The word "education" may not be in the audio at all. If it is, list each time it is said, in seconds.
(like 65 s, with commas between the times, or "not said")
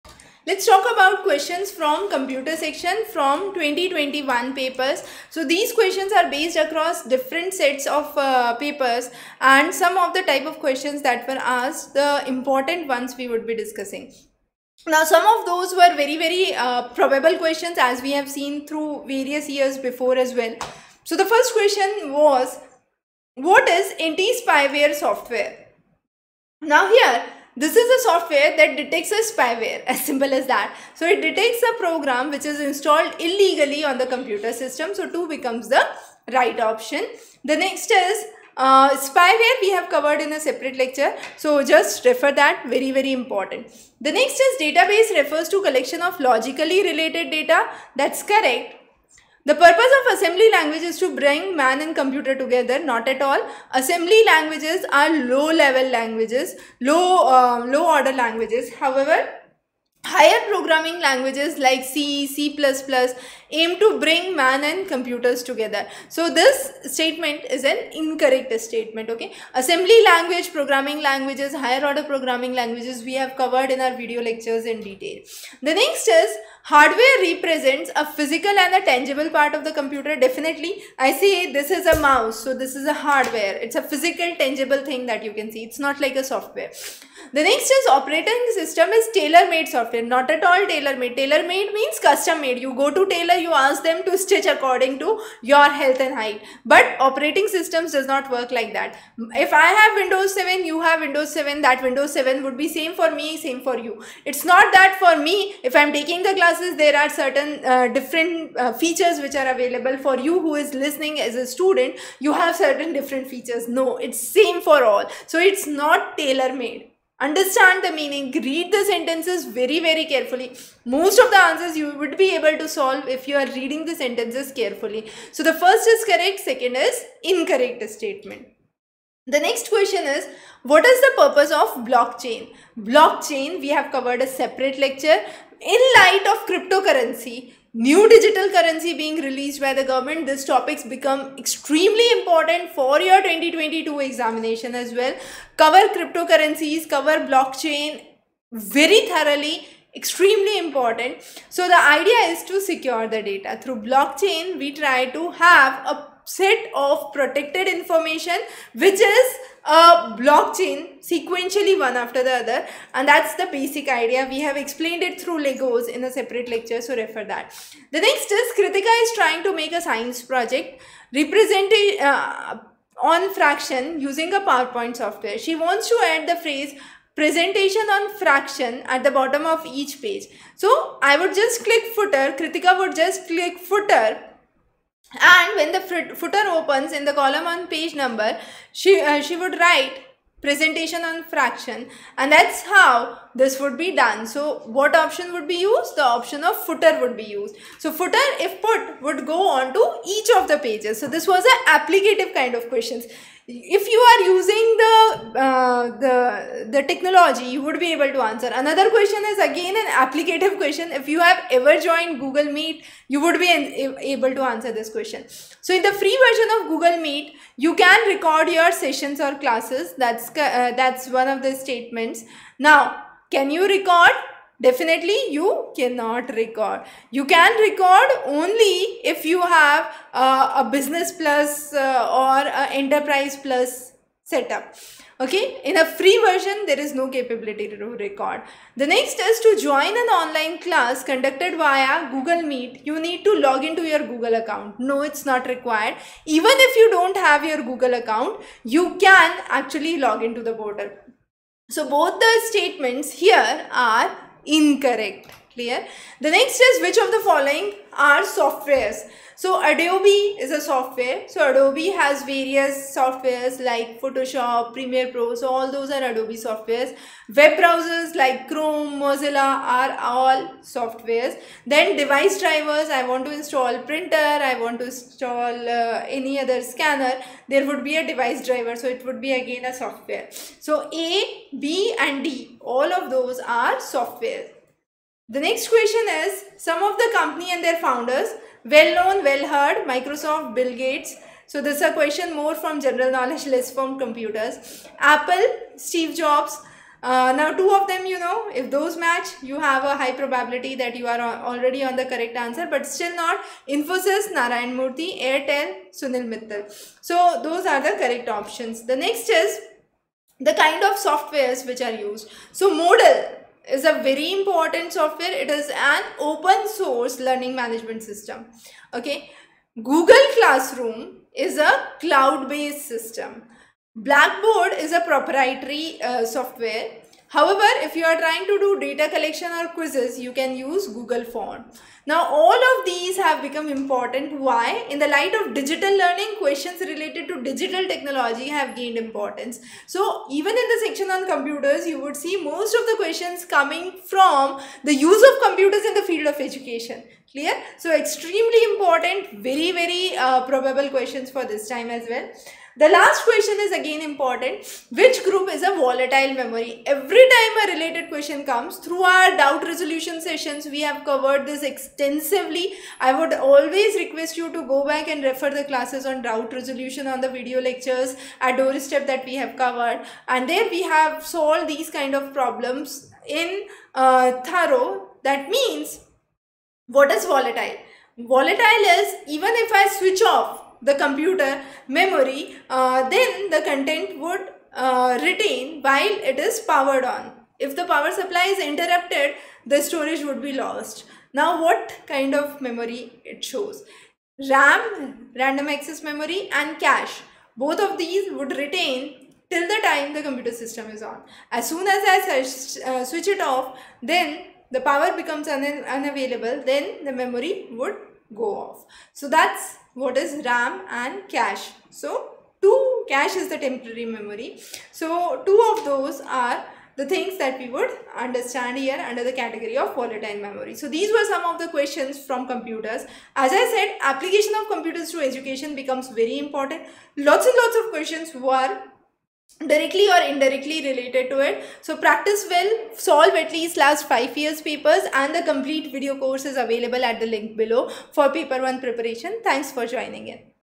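346 s, 425 s.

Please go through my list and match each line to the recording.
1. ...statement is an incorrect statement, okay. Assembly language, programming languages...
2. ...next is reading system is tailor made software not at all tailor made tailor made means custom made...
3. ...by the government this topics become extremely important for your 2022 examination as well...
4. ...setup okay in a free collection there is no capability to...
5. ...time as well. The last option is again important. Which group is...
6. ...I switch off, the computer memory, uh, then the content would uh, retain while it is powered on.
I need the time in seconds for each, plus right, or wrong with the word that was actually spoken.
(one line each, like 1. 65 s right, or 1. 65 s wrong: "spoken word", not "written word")
1. 66 s right
2. 87 s wrong: "operating", not "reading"
3. 139 s right
4. 234 s wrong: "version", not "collection"
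5. 351 s wrong: "question", not "option"
6. 379 s right.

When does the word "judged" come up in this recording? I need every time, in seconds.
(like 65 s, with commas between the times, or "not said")
not said.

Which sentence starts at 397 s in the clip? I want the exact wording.
Both of these would retain till the time the computer system is on.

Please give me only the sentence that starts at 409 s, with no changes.
So that's what is RAM and cache.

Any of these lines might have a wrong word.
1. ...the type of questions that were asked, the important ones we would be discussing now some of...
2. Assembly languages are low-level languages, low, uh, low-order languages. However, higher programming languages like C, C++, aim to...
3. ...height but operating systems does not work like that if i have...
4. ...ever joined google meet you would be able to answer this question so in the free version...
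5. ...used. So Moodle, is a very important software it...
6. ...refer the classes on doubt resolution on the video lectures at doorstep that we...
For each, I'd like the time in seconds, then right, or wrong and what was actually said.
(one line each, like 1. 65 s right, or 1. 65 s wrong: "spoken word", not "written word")
1. 10 s right
2. 53 s right
3. 96 s right
4. 211 s right
5. 311 s right
6. 365 s right.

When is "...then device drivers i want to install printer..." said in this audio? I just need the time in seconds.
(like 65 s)
271 s.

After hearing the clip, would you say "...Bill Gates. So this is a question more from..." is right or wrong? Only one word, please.
right.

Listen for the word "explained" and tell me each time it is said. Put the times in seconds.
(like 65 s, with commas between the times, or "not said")
164 s.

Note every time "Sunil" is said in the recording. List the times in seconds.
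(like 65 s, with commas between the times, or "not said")
305 s.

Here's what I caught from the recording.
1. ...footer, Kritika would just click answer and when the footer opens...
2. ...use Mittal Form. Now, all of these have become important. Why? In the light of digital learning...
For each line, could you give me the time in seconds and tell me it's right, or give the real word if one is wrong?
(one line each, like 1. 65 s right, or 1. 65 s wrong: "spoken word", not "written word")
1. 181 s wrong: "footer", not "answer"
2. 330 s wrong: "Google", not "Mittal".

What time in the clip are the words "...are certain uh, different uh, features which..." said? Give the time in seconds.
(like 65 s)
107 s.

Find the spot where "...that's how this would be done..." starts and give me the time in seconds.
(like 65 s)
192 s.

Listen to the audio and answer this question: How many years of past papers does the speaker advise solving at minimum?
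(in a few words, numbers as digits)
5.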